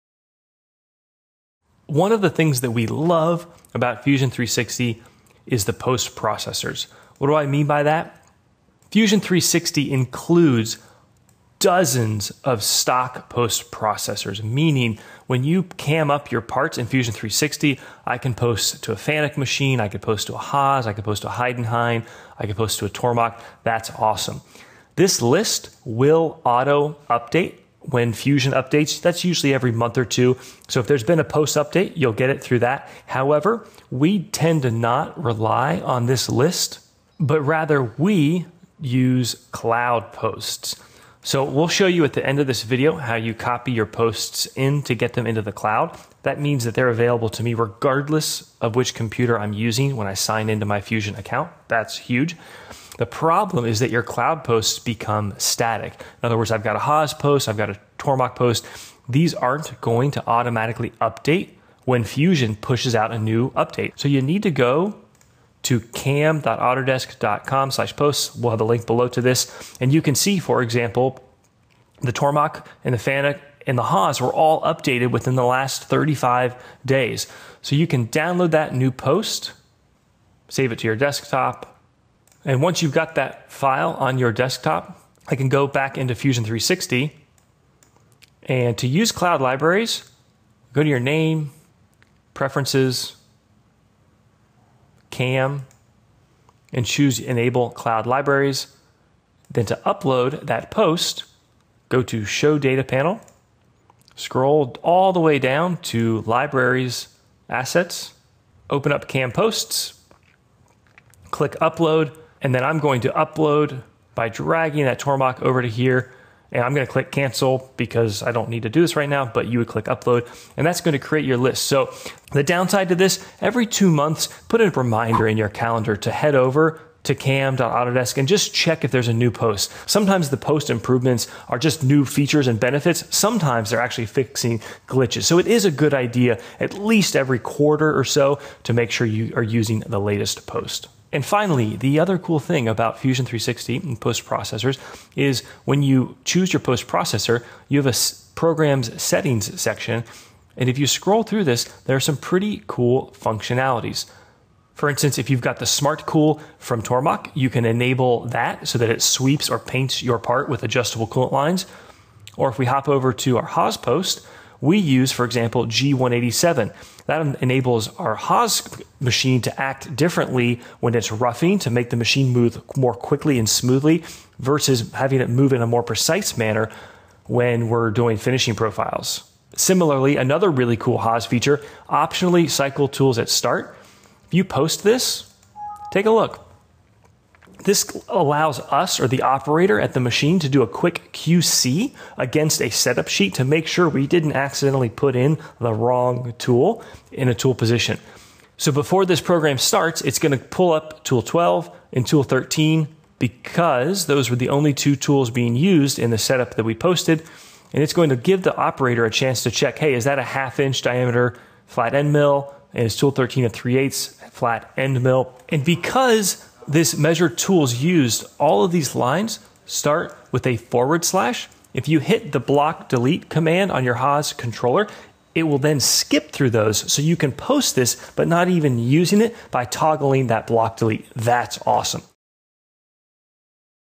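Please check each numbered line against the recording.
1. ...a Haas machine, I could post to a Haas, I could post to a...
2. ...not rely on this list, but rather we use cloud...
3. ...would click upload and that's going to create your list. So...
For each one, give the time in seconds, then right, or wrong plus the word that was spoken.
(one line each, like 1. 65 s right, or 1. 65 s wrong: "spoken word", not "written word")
1. 18 s wrong: "Fanuc", not "Haas"
2. 34 s right
3. 119 s right.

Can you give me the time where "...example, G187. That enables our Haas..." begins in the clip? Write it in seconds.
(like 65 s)
165 s.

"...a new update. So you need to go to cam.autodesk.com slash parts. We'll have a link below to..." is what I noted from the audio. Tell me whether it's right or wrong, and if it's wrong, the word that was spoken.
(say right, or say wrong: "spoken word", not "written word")
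wrong: "posts", not "parts".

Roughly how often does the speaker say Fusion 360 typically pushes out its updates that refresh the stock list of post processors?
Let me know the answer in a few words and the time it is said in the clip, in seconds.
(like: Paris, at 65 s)
every month or two, at 29 s.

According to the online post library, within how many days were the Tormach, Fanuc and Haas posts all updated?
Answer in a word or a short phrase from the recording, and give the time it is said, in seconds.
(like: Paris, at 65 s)
35 days, at 75 s.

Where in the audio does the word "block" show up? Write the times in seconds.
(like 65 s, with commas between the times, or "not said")
222 s, 230 s.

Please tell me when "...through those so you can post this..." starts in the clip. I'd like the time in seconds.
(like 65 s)
226 s.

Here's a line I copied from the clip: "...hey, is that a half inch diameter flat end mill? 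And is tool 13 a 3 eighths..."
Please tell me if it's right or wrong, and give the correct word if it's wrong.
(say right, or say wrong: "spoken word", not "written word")
right.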